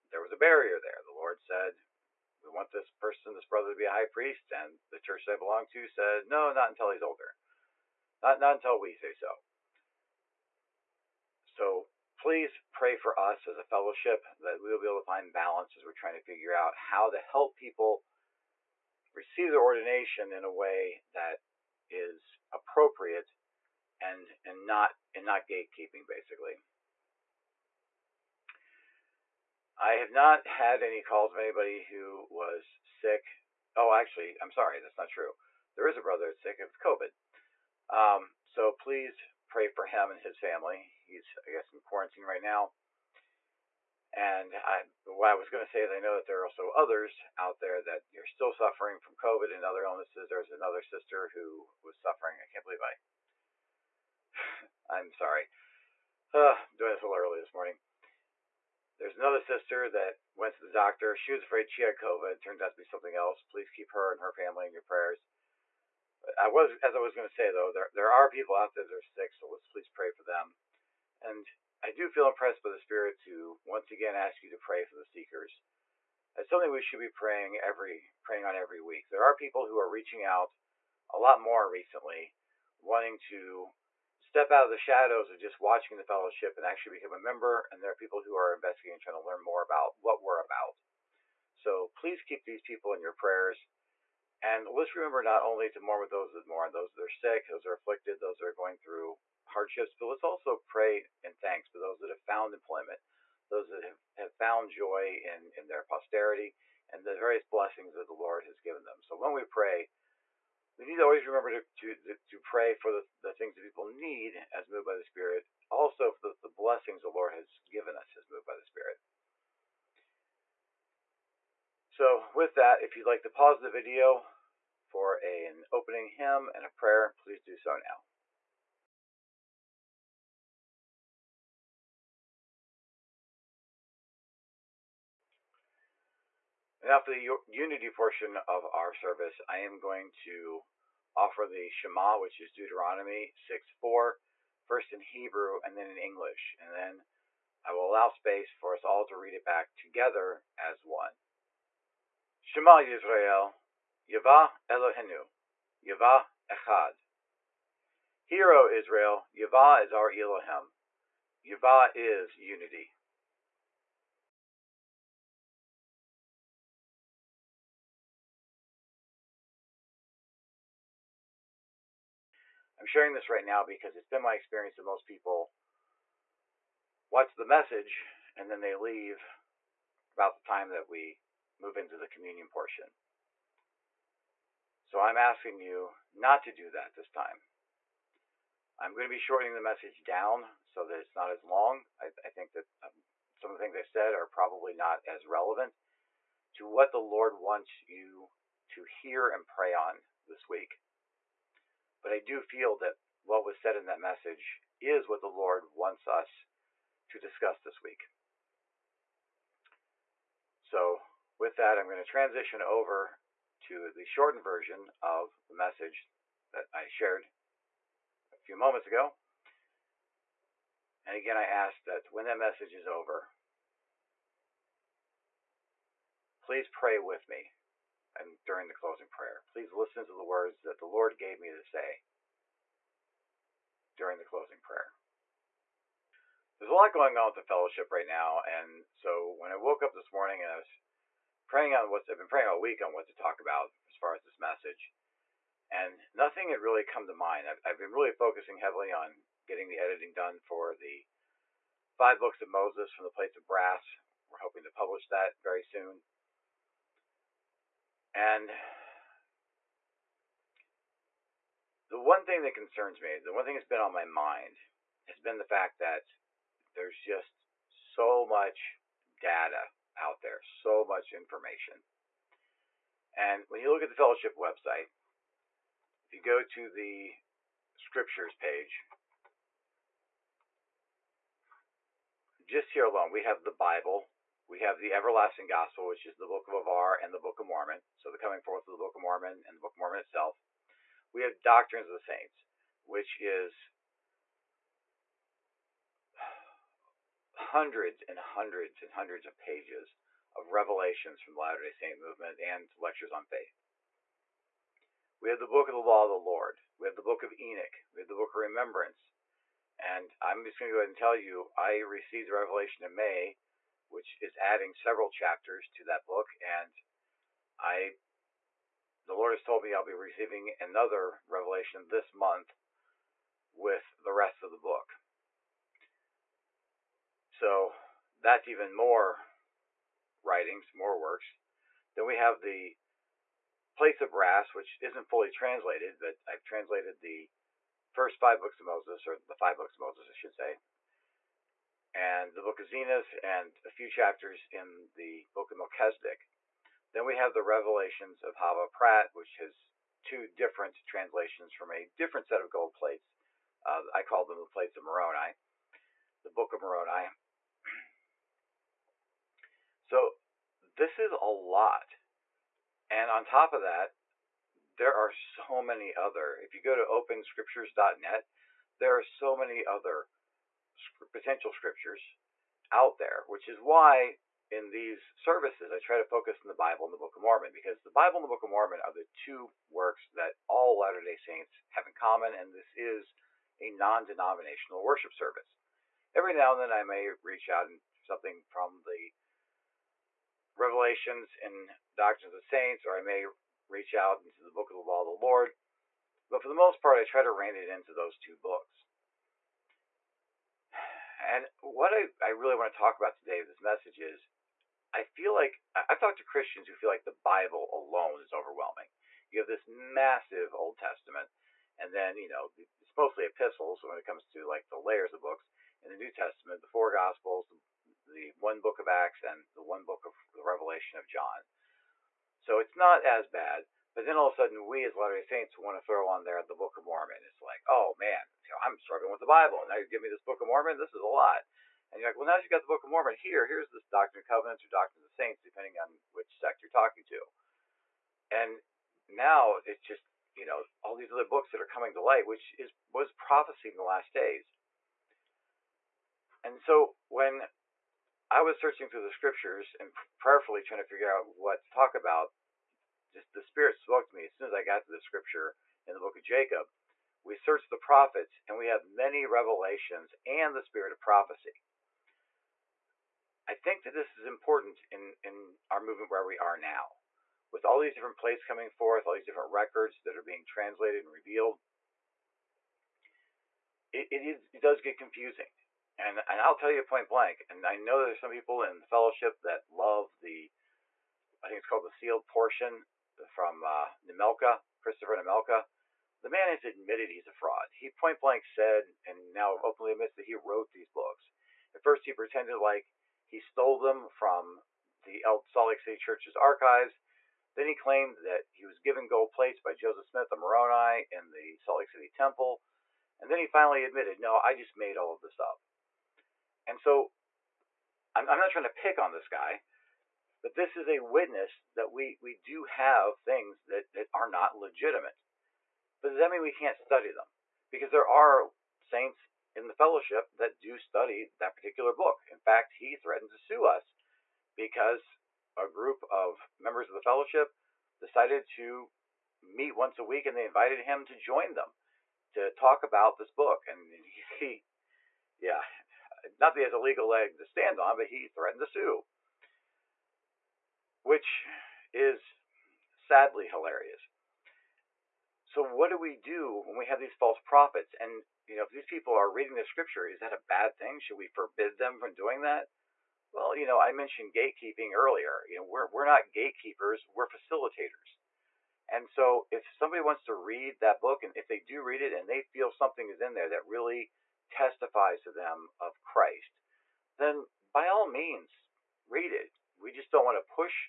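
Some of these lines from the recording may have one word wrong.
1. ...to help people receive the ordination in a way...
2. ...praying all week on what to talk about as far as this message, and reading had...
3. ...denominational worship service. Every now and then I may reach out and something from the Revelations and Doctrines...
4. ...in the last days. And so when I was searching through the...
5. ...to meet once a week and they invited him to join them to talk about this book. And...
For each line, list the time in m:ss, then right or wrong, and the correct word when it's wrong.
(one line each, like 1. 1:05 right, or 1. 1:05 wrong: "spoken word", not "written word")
1. 0:17 right
2. 4:02 wrong: "nothing", not "reading"
3. 6:24 right
4. 7:23 right
5. 8:48 right.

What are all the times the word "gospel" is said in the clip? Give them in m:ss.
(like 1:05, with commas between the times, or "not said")
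4:45, 6:56.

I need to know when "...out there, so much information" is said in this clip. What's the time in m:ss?
4:29.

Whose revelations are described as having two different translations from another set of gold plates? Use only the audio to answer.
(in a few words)
Hava Pratt.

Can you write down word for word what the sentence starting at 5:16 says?
And I, the Lord has told me I'll be receiving another revelation this month with the rest of the book.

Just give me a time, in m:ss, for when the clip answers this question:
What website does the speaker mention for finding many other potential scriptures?
6:06.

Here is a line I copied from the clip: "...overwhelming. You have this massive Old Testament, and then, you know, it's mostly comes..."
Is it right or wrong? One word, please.
wrong.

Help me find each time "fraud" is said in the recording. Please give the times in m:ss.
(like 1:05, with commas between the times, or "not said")
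8:07.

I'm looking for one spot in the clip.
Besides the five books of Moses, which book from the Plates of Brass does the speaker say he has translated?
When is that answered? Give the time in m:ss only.
5:42.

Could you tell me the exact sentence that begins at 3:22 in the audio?
But I do feel that what was said in that message is what the Lord wants us to discuss this week.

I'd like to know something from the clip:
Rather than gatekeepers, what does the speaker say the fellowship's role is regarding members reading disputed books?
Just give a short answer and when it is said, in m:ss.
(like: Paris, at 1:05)
facilitators, at 9:17.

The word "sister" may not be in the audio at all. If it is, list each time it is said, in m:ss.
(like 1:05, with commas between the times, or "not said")
0:50, 0:59.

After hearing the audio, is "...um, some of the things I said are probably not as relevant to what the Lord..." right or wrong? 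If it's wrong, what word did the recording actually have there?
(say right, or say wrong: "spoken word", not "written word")
right.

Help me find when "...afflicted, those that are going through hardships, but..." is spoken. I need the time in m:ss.
1:37.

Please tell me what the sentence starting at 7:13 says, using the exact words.
Here's this Doctrine of Covenants or Doctrine of the Saints, depending on which sect you're talking to.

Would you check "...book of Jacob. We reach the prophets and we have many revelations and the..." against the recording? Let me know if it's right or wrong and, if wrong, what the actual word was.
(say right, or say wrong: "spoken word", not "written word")
wrong: "search", not "reach".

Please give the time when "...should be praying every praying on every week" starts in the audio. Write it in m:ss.
1:16.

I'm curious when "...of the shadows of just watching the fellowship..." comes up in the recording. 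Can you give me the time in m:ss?
1:24.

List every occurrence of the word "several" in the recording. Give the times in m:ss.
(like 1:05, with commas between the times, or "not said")
5:14.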